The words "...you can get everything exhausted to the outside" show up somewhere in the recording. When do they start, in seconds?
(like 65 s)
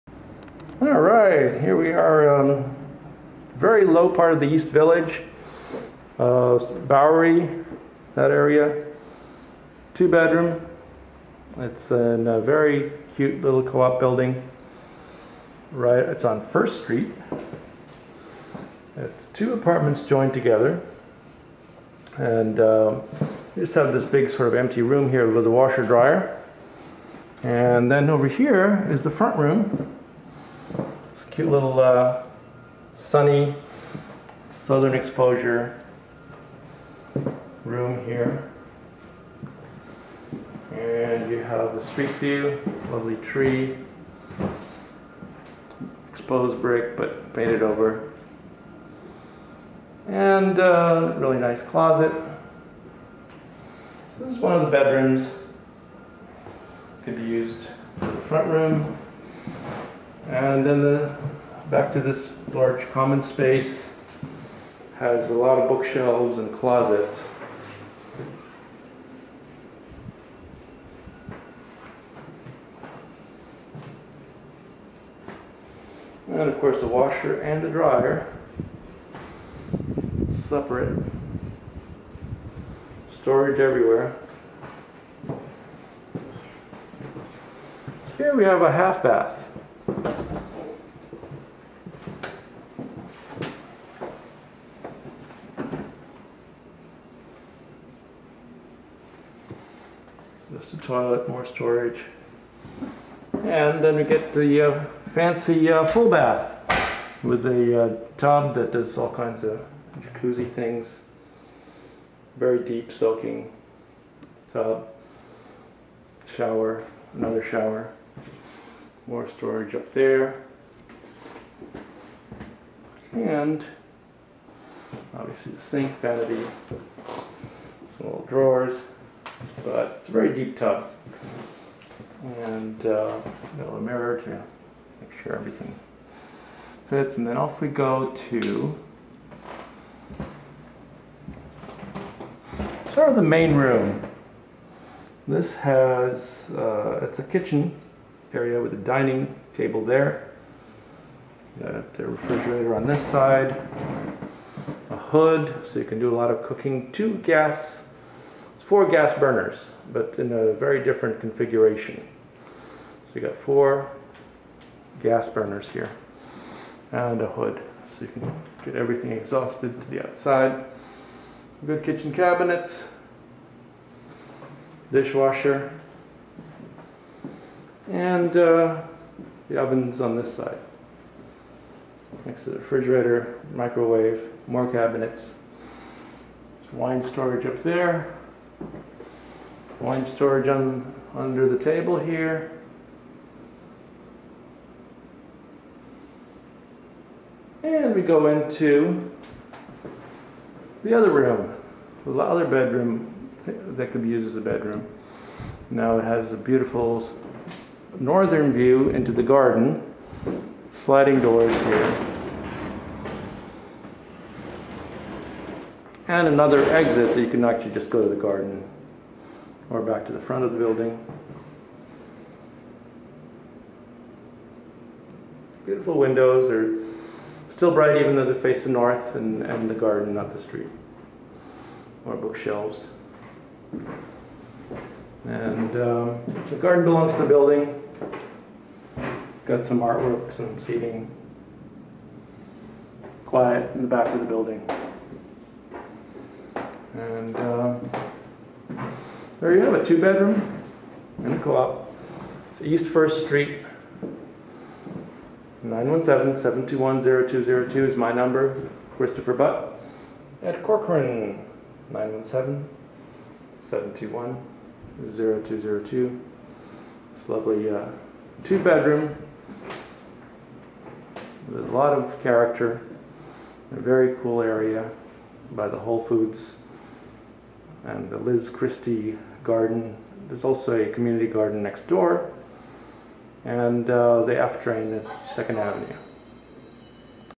168 s.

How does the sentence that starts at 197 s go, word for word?
And we go into the other room, the other bedroom that could be used as a bedroom.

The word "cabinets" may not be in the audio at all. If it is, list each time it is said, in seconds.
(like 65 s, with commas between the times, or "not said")
172 s, 184 s.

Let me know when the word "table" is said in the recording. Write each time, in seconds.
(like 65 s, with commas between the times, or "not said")
149 s, 191 s.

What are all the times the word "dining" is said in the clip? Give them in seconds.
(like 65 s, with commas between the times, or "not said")
148 s.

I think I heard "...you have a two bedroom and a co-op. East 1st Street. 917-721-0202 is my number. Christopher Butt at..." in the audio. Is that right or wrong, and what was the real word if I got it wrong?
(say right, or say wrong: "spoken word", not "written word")
right.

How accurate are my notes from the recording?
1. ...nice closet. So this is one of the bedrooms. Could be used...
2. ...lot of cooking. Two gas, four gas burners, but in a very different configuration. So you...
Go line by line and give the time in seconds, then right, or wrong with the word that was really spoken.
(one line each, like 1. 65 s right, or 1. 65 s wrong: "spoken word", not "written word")
1. 51 s right
2. 156 s right.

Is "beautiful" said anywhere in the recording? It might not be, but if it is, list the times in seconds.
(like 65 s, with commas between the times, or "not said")
206 s, 225 s.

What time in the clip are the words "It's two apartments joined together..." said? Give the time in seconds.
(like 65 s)
18 s.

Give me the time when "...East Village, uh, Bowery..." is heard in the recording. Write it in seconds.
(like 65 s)
4 s.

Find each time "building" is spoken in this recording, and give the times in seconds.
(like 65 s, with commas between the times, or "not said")
13 s, 220 s, 237 s, 244 s.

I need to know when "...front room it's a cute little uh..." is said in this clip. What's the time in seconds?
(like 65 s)
29 s.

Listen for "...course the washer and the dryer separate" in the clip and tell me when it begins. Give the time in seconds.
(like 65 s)
76 s.